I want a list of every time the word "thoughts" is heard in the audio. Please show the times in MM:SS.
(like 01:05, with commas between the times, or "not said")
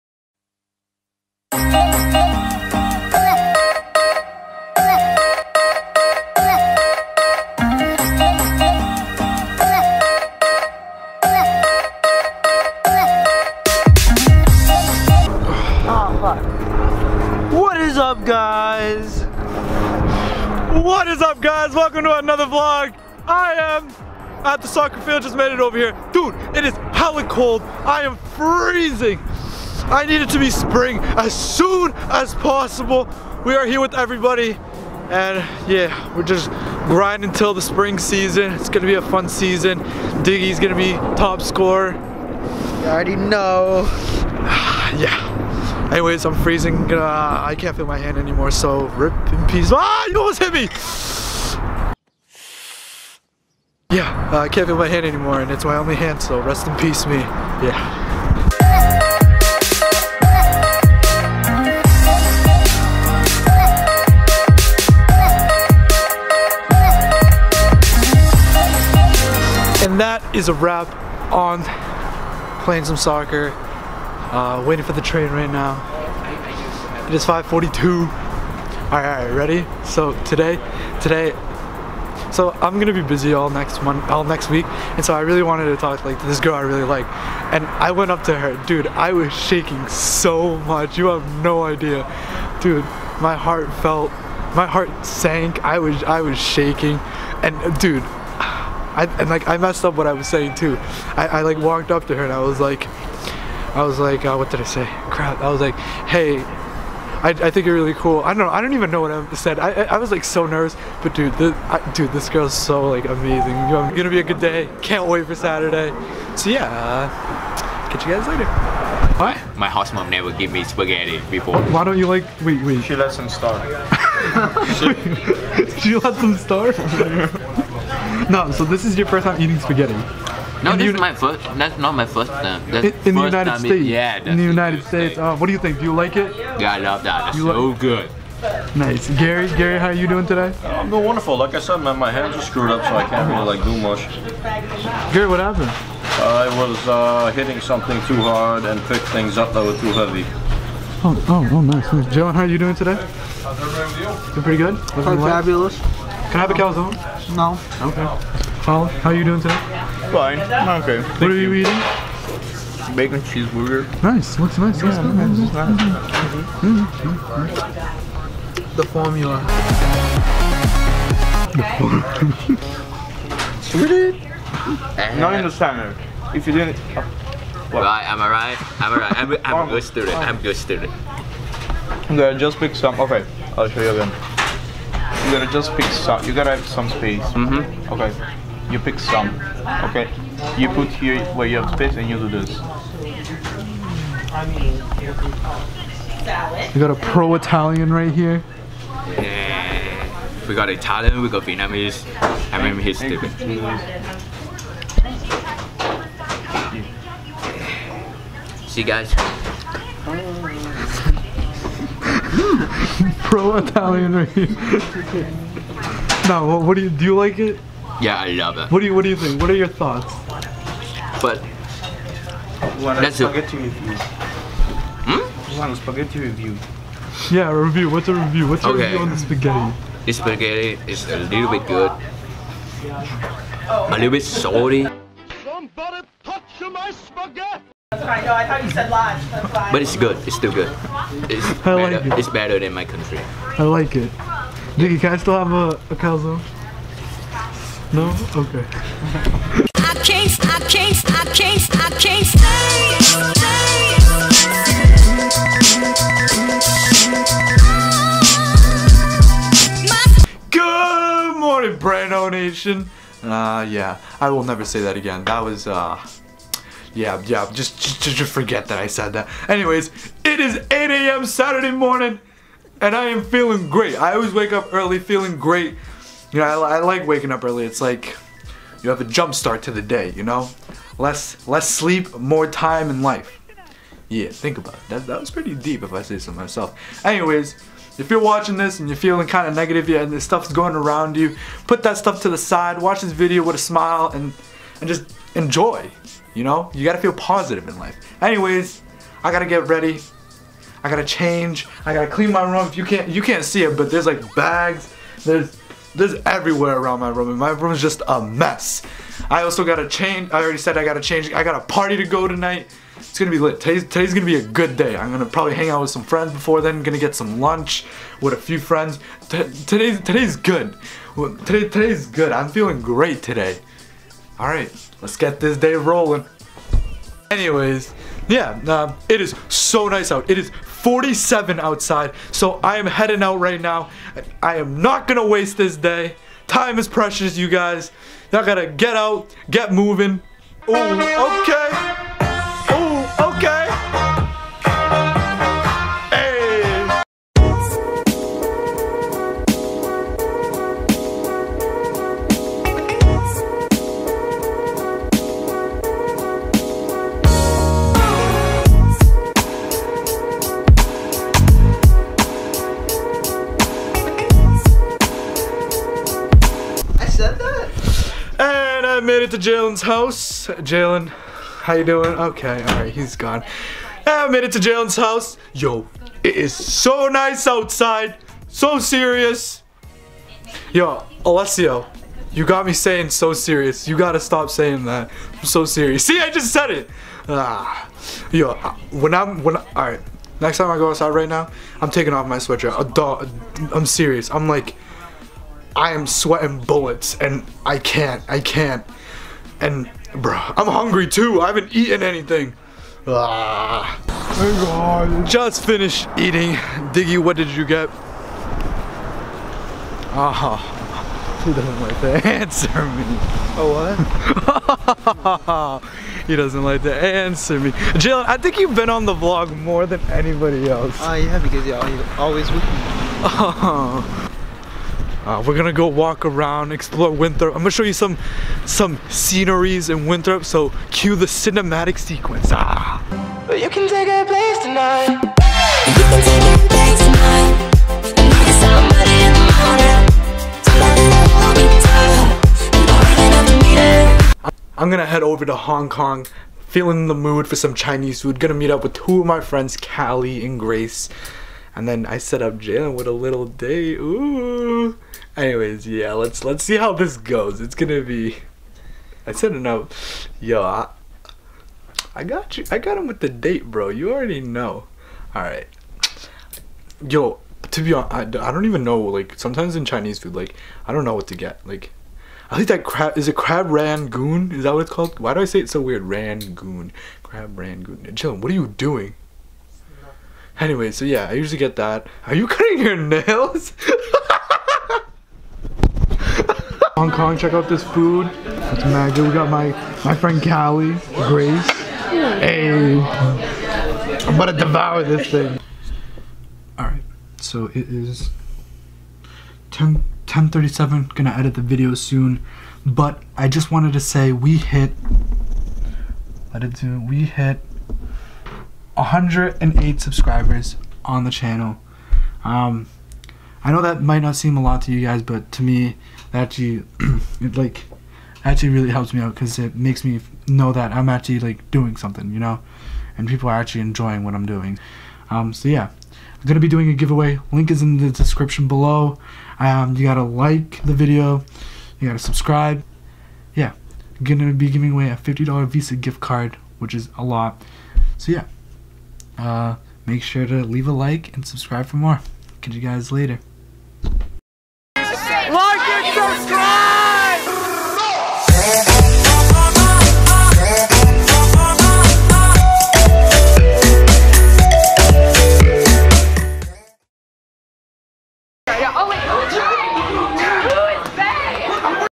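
03:39, 03:58.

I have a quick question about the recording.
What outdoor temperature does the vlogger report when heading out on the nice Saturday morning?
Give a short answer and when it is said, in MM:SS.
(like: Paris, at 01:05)
47, at 05:30.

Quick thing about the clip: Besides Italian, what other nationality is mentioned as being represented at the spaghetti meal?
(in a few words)
Vietnamese.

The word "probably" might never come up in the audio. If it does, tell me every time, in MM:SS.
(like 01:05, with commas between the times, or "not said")
05:15.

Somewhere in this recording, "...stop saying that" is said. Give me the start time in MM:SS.
06:24.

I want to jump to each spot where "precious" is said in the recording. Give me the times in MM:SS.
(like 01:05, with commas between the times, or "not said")
05:36.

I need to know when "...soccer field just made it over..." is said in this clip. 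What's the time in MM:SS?
00:24.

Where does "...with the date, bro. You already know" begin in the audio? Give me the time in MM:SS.
07:43.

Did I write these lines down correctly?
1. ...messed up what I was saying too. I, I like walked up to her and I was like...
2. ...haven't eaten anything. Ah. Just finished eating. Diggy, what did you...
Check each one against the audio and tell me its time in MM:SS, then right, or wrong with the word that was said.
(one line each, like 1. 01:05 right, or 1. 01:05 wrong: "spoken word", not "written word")
1. 01:39 right
2. 06:41 right.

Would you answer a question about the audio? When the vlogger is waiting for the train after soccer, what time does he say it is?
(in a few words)
5:42.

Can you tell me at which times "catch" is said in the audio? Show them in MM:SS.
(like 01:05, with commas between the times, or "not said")
01:57, 09:02.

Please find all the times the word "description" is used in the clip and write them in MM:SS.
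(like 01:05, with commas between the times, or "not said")
08:48.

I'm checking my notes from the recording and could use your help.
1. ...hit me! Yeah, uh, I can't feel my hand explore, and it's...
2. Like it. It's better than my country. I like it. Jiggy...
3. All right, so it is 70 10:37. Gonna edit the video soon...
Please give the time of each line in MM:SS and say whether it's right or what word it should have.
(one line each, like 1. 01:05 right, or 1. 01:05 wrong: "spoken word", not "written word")
1. 00:50 wrong: "anymore", not "explore"
2. 04:01 right
3. 08:16 wrong: "10", not "70".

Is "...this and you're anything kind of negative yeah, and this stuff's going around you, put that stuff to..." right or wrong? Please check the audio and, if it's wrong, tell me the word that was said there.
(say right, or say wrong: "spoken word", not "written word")
wrong: "feeling", not "anything".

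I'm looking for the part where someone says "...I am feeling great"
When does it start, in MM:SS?
04:32.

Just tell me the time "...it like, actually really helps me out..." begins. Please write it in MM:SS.
08:37.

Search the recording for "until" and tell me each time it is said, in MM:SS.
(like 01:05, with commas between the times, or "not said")
00:37.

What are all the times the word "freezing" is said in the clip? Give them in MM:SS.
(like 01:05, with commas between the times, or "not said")
00:28, 00:46.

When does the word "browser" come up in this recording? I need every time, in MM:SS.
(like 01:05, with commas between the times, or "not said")
not said.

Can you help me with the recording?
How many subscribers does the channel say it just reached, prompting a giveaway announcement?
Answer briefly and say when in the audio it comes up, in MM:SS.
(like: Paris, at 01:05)
108, at 08:29.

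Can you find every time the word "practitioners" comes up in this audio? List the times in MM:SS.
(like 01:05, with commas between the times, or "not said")
not said.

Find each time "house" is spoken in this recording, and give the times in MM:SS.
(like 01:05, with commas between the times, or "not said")
01:59, 06:09, 06:14.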